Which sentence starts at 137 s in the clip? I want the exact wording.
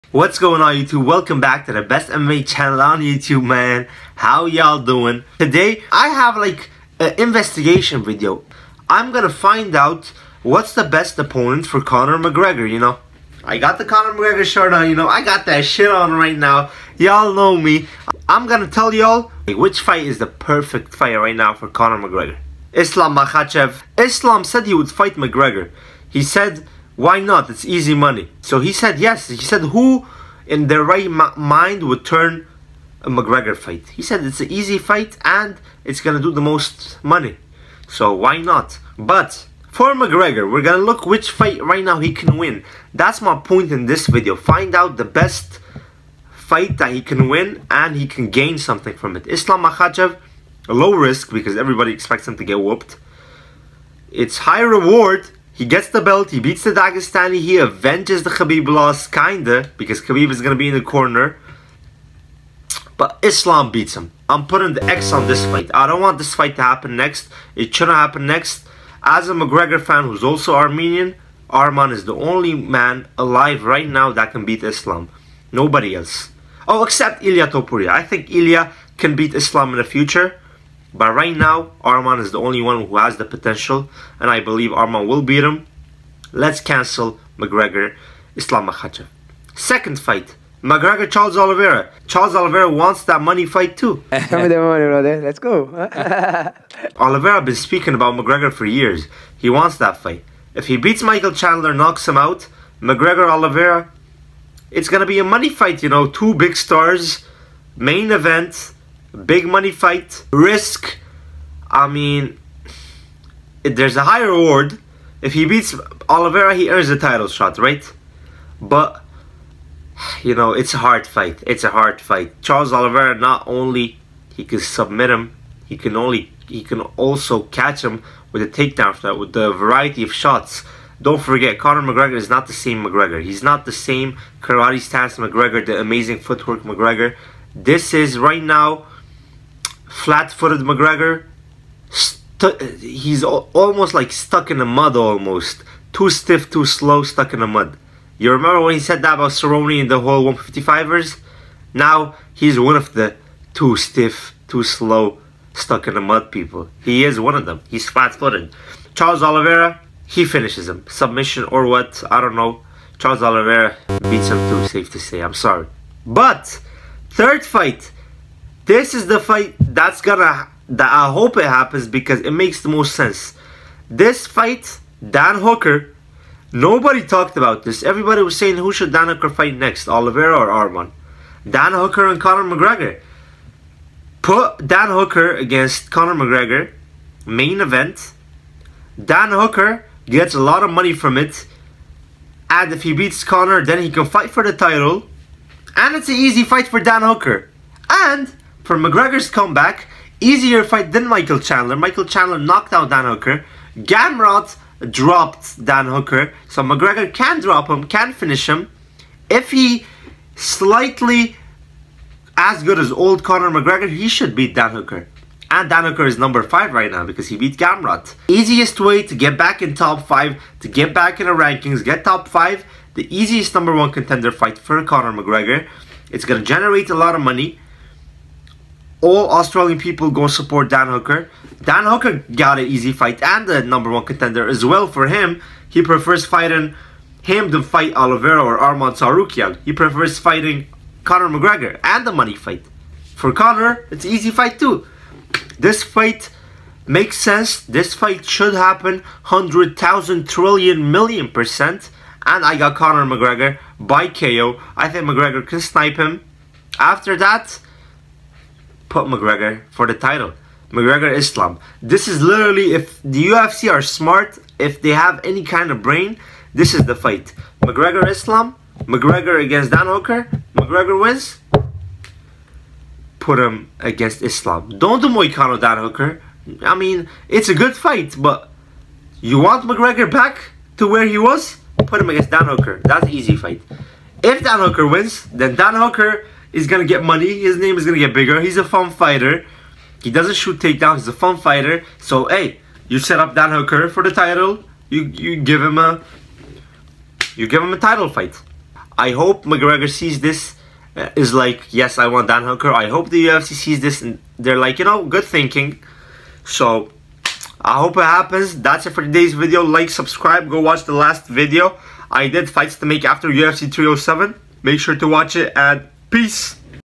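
This is, right now, flat-footed McGregor, he's almost like stuck in the mud almost.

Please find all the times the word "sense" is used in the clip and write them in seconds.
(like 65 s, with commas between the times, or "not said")
172 s, 247 s.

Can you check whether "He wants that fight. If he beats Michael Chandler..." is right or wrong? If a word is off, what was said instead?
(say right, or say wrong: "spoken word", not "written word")
right.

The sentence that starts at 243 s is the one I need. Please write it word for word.
For Conor, it's an easy fight too.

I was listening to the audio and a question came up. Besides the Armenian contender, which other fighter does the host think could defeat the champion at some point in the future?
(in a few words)
Ilya Topuria.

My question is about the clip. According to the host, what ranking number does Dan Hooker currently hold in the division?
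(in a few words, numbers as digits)
5.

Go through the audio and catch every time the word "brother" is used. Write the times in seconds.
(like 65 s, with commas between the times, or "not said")
94 s.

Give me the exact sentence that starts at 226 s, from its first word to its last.
It's going to generate a lot of money all Australian people go support Dan Hooker.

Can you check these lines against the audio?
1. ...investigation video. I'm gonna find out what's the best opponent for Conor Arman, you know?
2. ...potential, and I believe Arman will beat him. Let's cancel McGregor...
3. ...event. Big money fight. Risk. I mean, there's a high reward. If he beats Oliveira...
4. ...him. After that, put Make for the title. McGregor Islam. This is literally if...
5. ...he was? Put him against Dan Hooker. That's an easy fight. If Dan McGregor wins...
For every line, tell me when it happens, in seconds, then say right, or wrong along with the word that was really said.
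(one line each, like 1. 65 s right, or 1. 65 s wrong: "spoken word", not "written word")
1. 7 s wrong: "McGregor", not "Arman"
2. 83 s right
3. 108 s right
4. 255 s wrong: "McGregor", not "Make"
5. 281 s wrong: "Hooker", not "McGregor".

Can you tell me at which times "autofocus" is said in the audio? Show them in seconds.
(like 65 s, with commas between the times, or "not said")
not said.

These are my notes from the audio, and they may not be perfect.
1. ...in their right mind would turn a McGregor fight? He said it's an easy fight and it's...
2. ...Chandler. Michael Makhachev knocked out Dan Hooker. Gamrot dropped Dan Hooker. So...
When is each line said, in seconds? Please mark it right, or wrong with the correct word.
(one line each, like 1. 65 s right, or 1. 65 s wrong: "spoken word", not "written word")
1. 30 s right
2. 201 s wrong: "Chandler", not "Makhachev".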